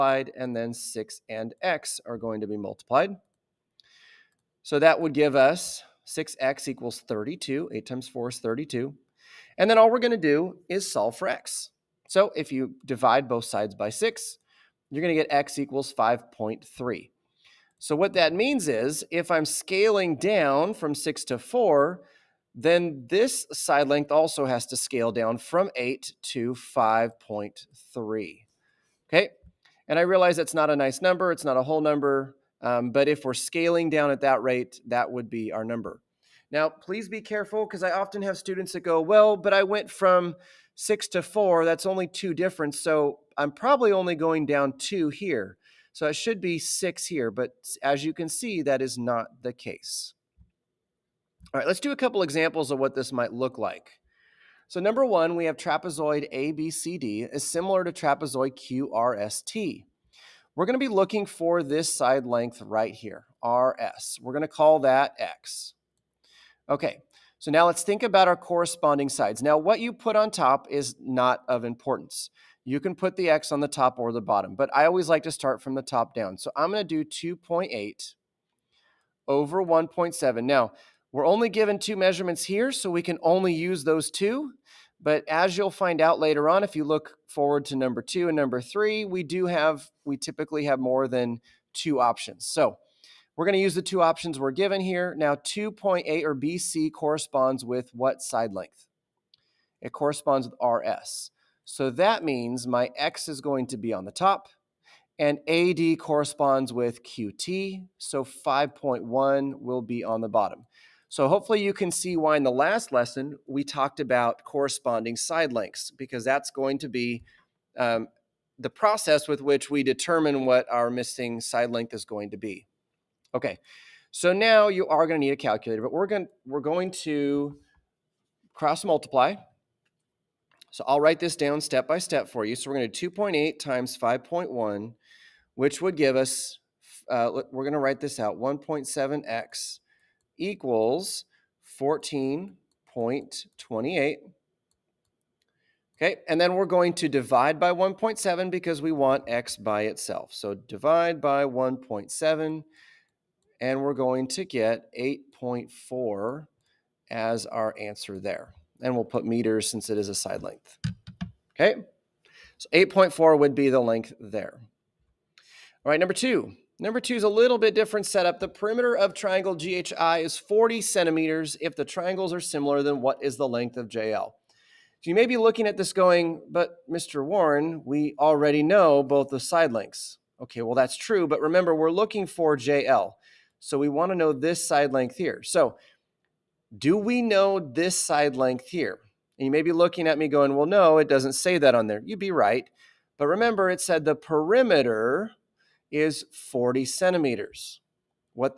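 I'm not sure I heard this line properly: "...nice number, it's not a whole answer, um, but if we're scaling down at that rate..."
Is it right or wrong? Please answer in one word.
wrong.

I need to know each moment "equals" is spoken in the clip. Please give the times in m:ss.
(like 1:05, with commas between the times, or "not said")
0:06, 0:15, 2:20.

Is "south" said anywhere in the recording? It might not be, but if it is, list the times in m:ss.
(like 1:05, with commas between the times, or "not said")
not said.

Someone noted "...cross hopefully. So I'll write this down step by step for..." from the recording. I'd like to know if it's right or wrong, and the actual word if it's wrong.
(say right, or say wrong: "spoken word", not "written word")
wrong: "multiply", not "hopefully".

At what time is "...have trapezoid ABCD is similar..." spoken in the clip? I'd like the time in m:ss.
0:55.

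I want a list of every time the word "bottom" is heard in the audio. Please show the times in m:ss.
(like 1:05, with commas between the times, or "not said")
1:14, 1:50.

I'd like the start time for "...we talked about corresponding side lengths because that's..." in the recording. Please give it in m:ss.
1:53.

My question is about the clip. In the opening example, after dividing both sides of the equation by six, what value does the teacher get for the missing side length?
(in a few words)
5.3.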